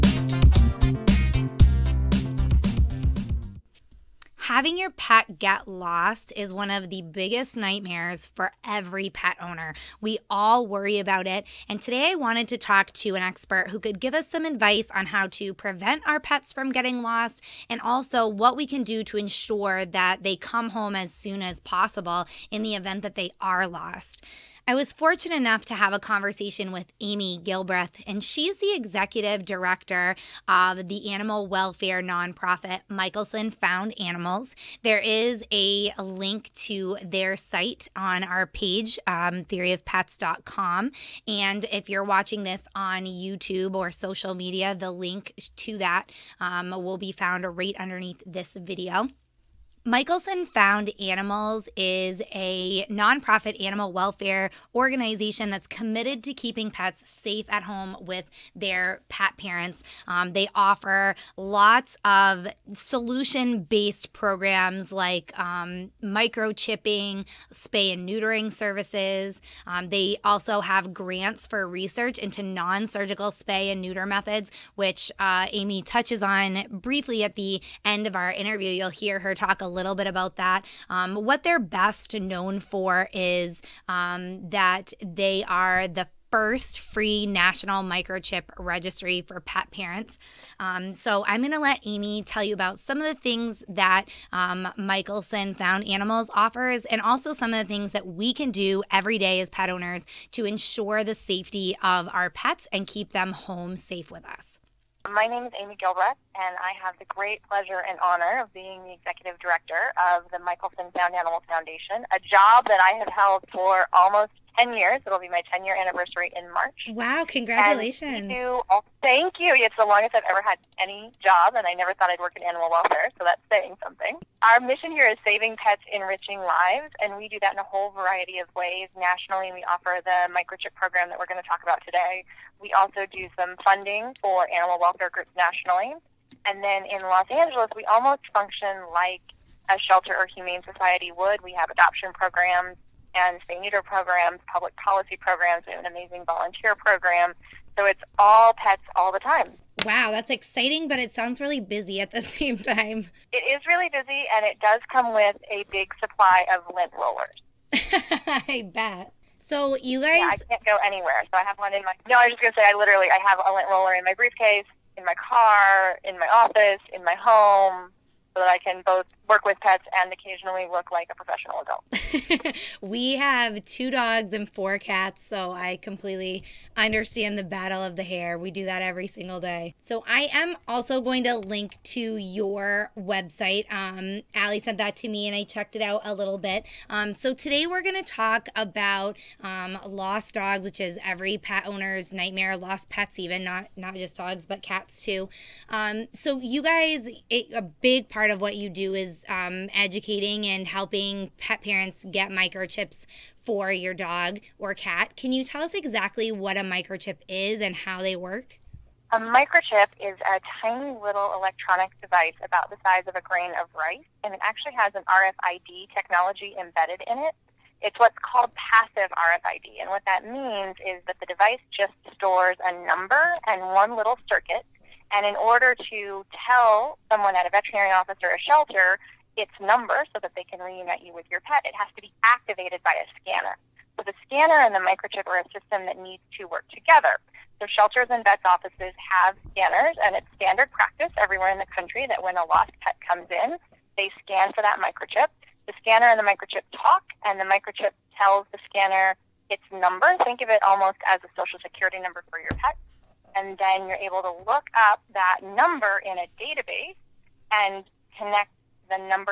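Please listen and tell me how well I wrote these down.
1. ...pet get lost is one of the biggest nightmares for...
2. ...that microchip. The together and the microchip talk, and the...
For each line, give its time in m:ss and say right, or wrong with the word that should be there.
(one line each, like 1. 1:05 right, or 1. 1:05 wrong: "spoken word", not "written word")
1. 0:04 right
2. 4:04 wrong: "scanner", not "together".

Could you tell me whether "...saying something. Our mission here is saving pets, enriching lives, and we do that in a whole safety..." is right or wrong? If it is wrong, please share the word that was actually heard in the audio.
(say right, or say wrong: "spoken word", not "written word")
wrong: "variety", not "safety".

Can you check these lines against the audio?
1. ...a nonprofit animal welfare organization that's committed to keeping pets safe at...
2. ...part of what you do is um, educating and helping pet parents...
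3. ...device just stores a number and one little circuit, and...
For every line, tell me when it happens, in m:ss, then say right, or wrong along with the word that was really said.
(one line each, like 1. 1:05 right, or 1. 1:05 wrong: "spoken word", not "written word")
1. 0:52 right
2. 3:18 right
3. 3:41 right.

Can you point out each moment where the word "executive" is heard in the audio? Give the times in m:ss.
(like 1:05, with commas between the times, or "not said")
0:28, 1:48.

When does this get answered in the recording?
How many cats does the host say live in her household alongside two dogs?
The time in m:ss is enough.
2:54.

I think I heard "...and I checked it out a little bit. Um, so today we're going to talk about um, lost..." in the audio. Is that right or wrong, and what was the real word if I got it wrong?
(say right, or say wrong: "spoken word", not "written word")
right.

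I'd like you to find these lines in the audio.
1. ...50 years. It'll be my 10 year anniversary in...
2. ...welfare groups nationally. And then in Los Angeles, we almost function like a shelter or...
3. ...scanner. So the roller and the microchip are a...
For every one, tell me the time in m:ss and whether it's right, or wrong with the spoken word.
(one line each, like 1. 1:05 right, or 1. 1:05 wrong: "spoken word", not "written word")
1. 1:54 wrong: "10", not "50"
2. 2:14 right
3. 3:53 wrong: "scanner", not "roller".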